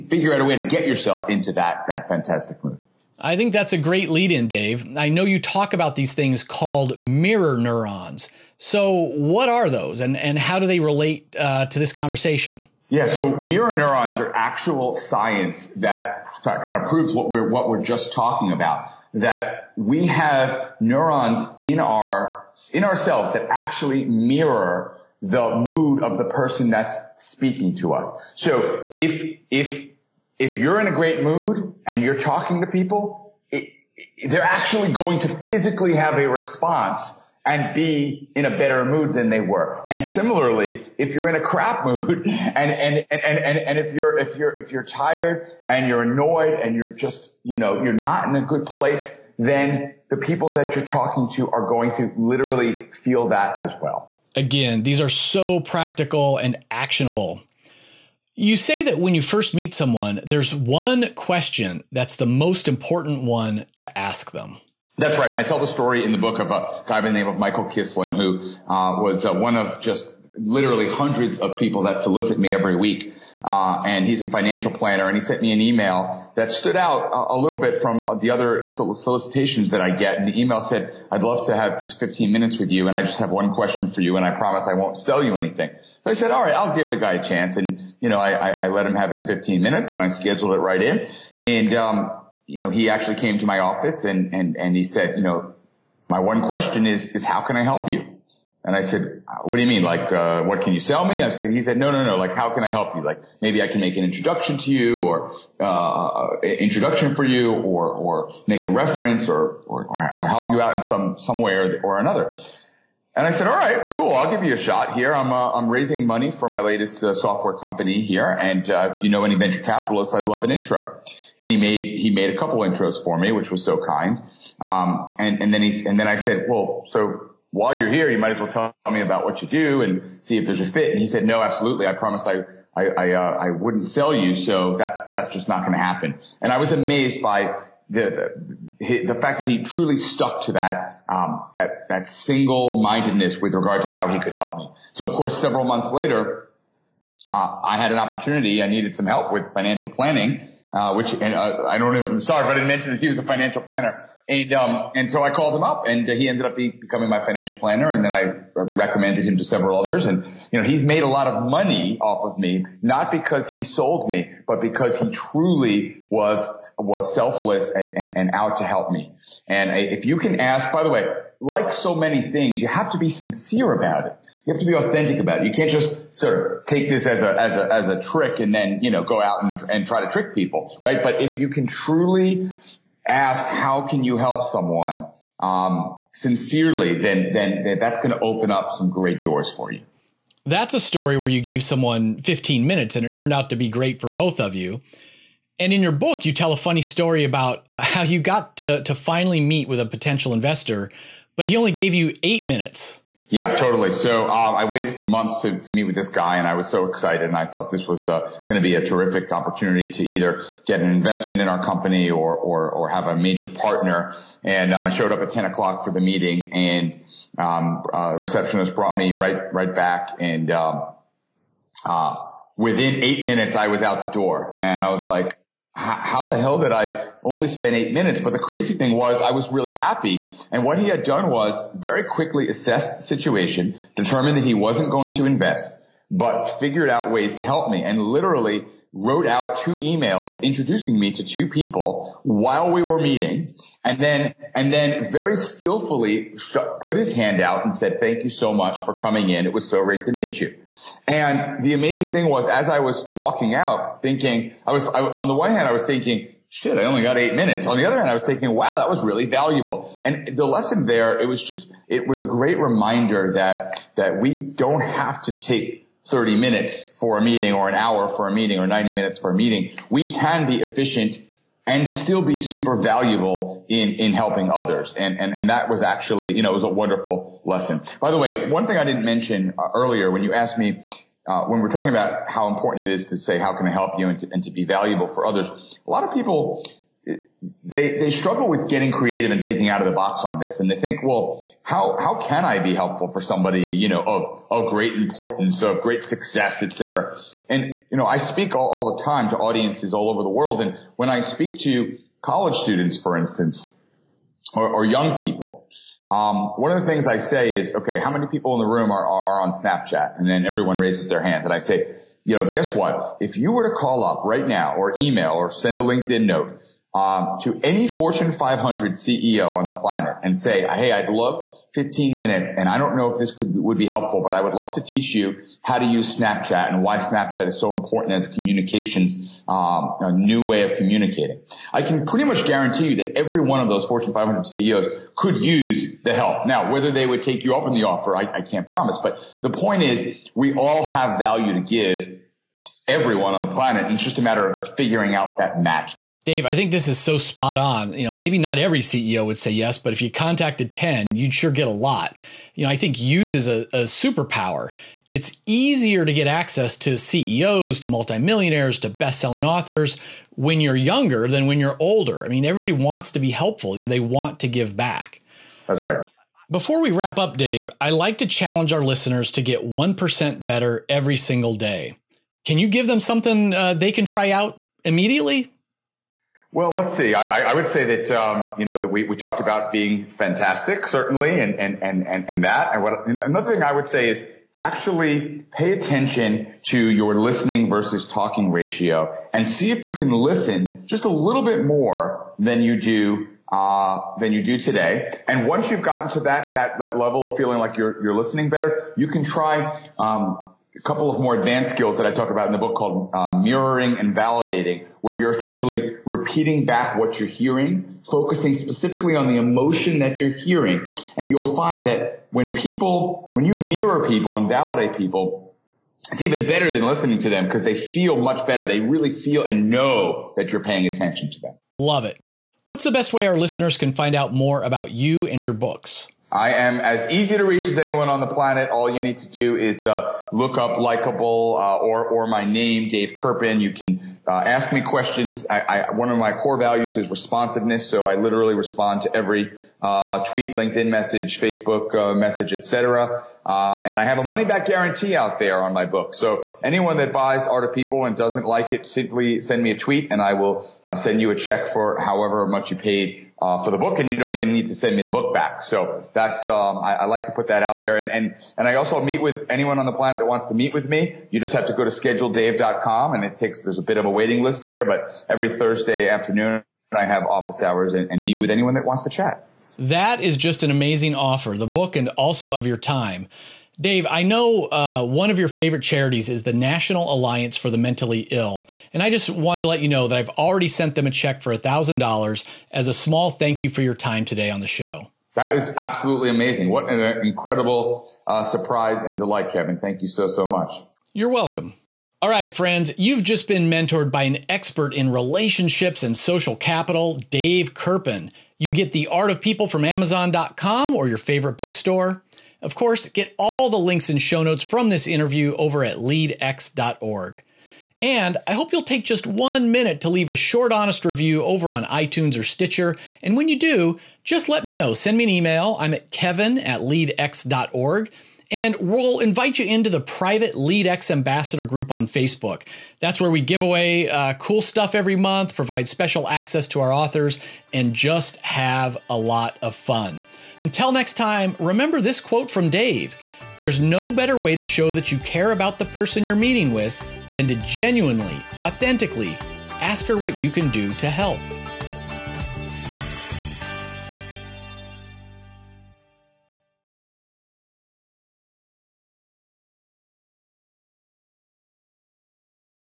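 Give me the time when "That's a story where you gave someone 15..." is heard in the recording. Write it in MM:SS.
03:10.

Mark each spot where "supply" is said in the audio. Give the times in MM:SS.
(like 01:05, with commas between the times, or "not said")
not said.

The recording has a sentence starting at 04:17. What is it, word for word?
On the other hand, I was thinking, wow, that was really valuable.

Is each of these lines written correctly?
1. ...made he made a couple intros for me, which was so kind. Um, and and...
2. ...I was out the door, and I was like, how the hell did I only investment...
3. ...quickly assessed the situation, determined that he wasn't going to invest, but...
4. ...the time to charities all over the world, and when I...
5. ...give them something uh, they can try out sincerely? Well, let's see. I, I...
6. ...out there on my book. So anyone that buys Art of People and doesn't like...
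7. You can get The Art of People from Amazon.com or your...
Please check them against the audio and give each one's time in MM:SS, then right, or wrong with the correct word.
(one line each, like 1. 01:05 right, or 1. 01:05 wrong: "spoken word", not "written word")
1. 02:01 right
2. 03:43 wrong: "spent", not "investment"
3. 03:52 right
4. 04:58 wrong: "audiences", not "charities"
5. 06:12 wrong: "immediately", not "sincerely"
6. 07:25 right
7. 08:18 right.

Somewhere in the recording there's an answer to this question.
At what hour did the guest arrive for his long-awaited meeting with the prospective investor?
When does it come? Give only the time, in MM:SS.
03:35.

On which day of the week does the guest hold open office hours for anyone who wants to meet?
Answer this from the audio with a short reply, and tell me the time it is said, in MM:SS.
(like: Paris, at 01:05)
Thursday, at 07:45.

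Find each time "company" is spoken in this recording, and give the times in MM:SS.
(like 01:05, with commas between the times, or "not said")
01:57, 03:31.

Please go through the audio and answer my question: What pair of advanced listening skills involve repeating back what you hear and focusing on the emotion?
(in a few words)
mirroring and validating.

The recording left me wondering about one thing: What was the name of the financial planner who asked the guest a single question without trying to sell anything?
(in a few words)
Michael Kislin.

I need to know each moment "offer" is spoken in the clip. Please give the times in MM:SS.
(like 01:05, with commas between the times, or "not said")
05:37, 07:51.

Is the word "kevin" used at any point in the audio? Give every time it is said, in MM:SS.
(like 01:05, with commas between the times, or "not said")
08:09, 08:36.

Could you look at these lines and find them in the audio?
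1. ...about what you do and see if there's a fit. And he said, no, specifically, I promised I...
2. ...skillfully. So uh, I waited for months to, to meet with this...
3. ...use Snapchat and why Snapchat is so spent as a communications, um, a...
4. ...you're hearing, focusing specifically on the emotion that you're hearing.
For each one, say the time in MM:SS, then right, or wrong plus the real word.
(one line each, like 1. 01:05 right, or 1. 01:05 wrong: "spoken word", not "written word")
1. 02:09 wrong: "absolutely", not "specifically"
2. 03:23 wrong: "totally", not "skillfully"
3. 05:25 wrong: "important", not "spent"
4. 06:47 right.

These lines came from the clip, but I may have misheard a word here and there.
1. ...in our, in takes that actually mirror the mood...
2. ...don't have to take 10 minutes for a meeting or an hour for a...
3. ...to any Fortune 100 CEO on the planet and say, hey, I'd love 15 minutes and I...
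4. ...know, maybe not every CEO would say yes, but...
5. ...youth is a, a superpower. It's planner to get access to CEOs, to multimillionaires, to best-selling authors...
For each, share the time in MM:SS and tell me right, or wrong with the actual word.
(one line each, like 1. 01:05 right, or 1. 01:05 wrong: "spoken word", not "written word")
1. 00:21 wrong: "ourselves", not "takes"
2. 04:24 wrong: "30", not "10"
3. 05:17 wrong: "500", not "100"
4. 05:48 right
5. 05:53 wrong: "easier", not "planner".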